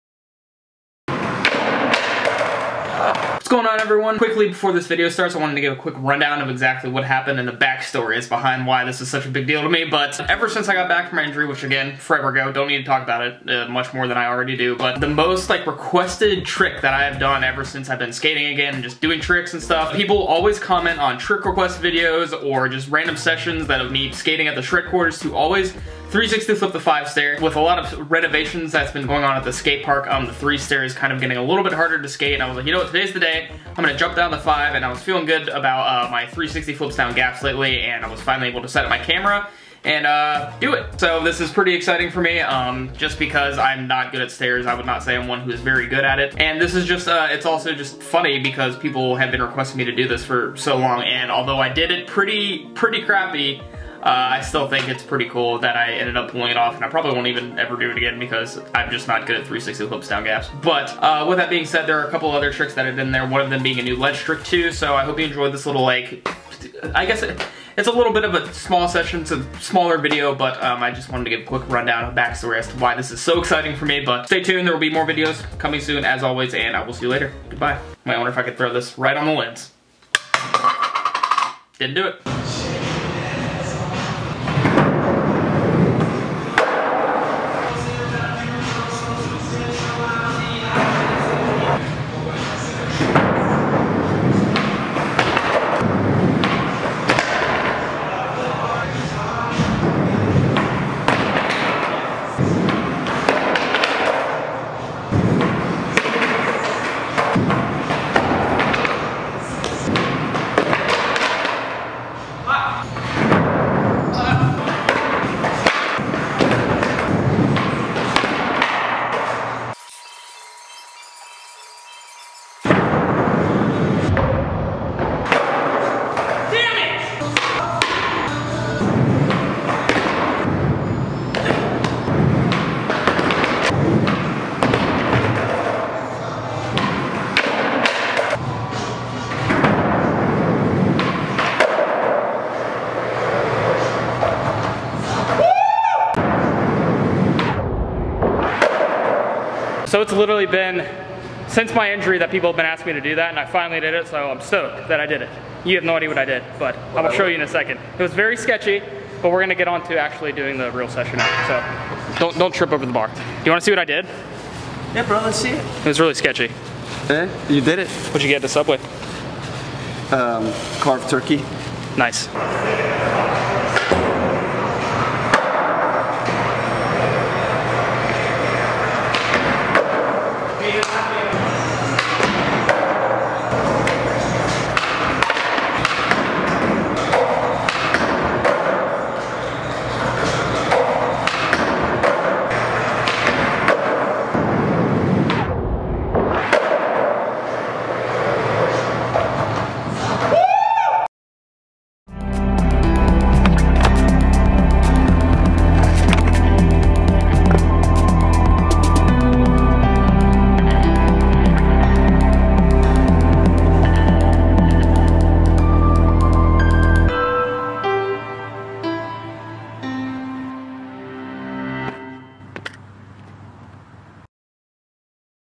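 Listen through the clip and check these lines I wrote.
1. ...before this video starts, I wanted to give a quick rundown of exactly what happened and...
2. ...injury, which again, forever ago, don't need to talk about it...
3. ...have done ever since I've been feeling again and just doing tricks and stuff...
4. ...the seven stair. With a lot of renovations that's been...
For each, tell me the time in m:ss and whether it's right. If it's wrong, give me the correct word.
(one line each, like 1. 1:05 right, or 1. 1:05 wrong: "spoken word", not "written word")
1. 0:04 right
2. 0:11 right
3. 0:17 wrong: "skating", not "feeling"
4. 0:26 wrong: "five", not "seven".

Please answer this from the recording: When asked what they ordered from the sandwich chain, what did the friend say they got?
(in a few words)
Carved turkey.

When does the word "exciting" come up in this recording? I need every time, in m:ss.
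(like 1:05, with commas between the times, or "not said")
0:41, 1:13.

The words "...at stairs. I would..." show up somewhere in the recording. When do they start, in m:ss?
0:44.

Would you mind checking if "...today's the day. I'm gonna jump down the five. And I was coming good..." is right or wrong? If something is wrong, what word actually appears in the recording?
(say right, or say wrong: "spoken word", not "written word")
wrong: "feeling", not "coming".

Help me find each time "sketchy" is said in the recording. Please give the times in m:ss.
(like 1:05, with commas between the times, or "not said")
2:38, 2:46.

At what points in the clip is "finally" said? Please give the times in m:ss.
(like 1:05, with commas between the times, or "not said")
0:38, 2:33.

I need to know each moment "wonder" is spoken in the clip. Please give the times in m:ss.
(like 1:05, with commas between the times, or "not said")
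1:18.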